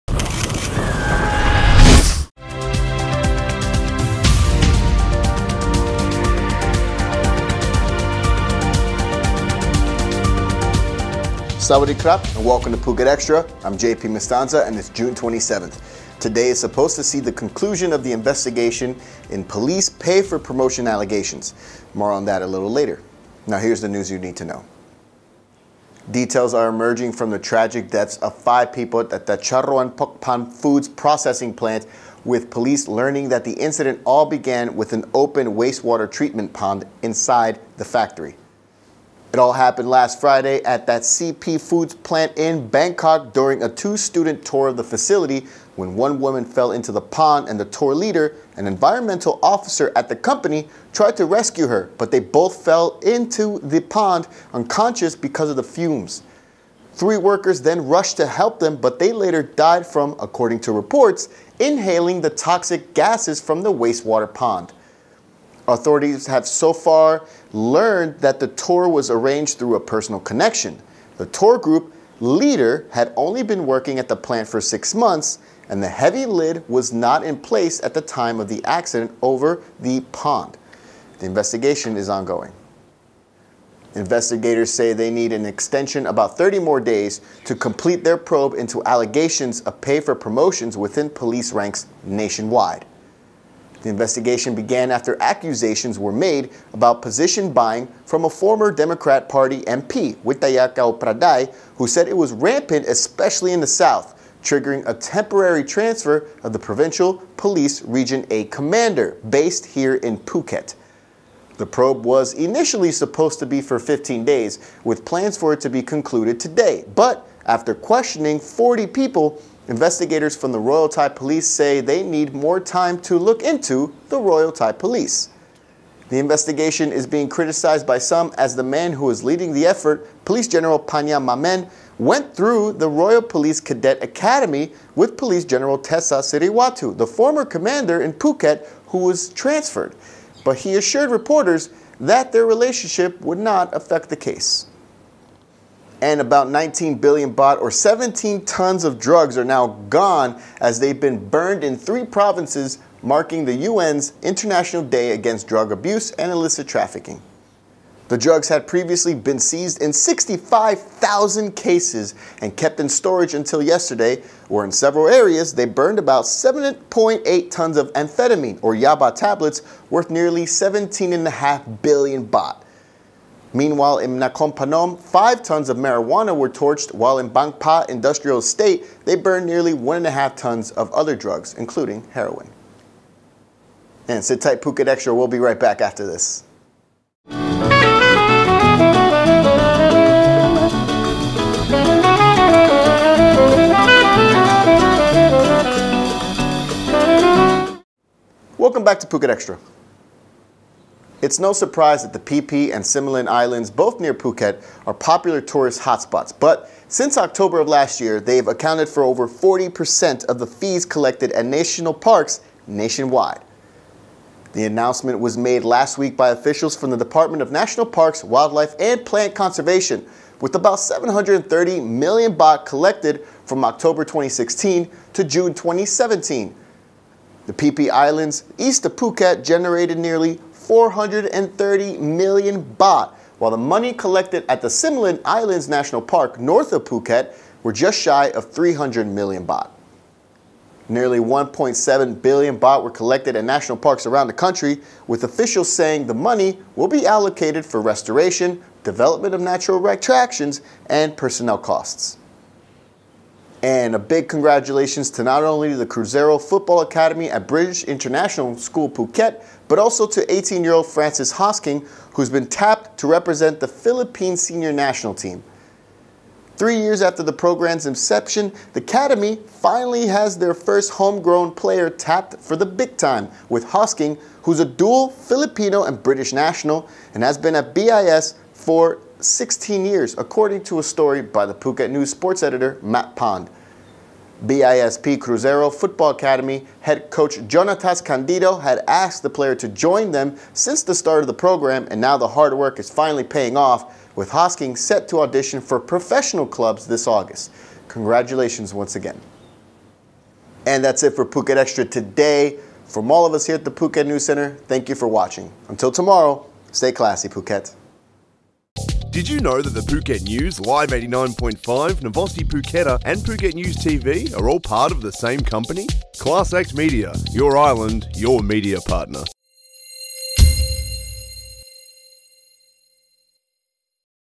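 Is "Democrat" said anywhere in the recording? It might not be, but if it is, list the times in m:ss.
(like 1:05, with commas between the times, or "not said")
1:38.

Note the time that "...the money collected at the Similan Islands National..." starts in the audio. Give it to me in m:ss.
3:53.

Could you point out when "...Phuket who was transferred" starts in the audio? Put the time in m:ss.
2:18.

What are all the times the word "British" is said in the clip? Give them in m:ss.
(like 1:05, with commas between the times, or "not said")
4:17, 4:36.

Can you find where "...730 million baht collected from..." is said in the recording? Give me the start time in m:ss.
3:40.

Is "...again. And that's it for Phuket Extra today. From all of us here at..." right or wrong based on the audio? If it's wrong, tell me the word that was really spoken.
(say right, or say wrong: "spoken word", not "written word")
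right.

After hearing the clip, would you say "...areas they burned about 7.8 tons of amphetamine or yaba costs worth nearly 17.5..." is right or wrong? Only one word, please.
wrong.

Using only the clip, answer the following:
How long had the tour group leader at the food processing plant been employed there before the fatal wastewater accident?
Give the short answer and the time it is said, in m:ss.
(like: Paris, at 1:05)
6 months, at 1:14.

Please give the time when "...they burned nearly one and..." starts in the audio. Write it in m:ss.
2:59.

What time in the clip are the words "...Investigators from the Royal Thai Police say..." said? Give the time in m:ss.
1:59.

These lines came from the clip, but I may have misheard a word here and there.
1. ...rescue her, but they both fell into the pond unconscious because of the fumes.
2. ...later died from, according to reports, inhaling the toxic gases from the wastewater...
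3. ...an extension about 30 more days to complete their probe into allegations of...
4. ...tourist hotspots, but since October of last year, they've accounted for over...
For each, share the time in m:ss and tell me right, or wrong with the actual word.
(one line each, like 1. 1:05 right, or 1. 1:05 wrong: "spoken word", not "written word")
1. 0:51 right
2. 0:59 right
3. 1:25 right
4. 3:25 right.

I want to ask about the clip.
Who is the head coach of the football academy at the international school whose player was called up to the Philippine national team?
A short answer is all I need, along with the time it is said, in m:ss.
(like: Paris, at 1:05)
Jonatas Candido, at 4:47.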